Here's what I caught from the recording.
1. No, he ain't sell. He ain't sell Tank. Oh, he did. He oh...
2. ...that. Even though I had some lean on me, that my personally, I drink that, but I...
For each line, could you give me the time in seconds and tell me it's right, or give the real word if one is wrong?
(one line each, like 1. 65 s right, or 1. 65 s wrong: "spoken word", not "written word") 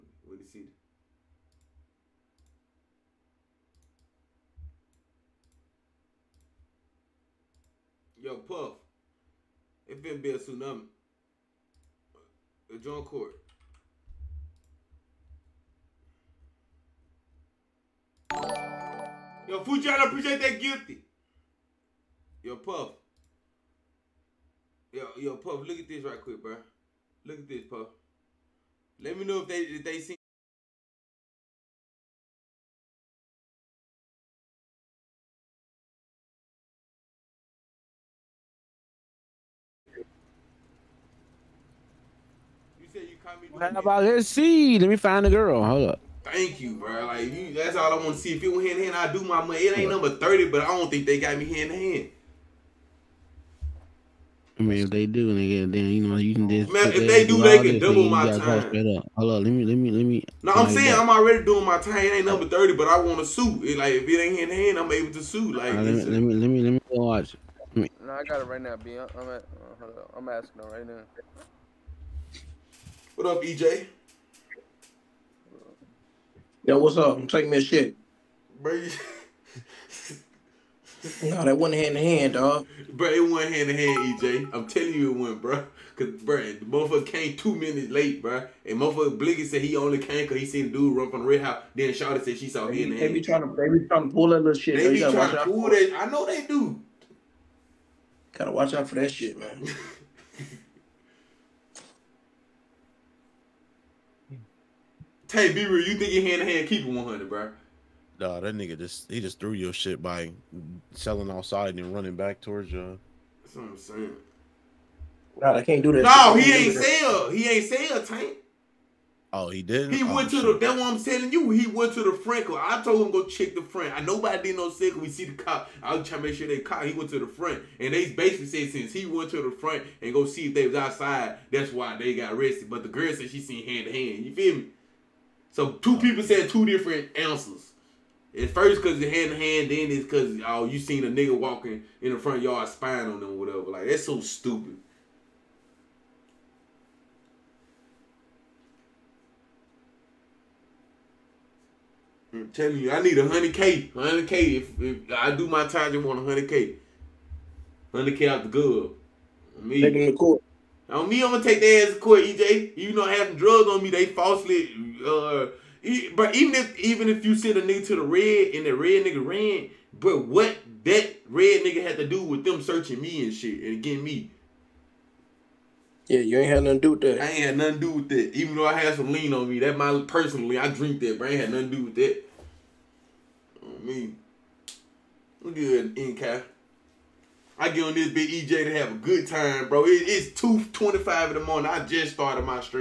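1. 116 s right
2. 178 s right.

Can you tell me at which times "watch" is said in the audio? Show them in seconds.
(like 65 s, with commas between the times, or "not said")
66 s, 98 s.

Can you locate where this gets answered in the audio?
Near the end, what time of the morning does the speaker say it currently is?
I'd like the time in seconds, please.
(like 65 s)
190 s.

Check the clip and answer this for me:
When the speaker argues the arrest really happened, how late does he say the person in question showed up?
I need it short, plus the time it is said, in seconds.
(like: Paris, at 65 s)
2 minutes, at 87 s.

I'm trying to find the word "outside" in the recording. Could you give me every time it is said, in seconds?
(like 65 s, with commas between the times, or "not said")
111 s, 130 s.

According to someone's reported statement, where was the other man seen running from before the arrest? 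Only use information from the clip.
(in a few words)
the red house.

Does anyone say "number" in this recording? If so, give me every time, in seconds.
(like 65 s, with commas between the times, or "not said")
49 s, 62 s.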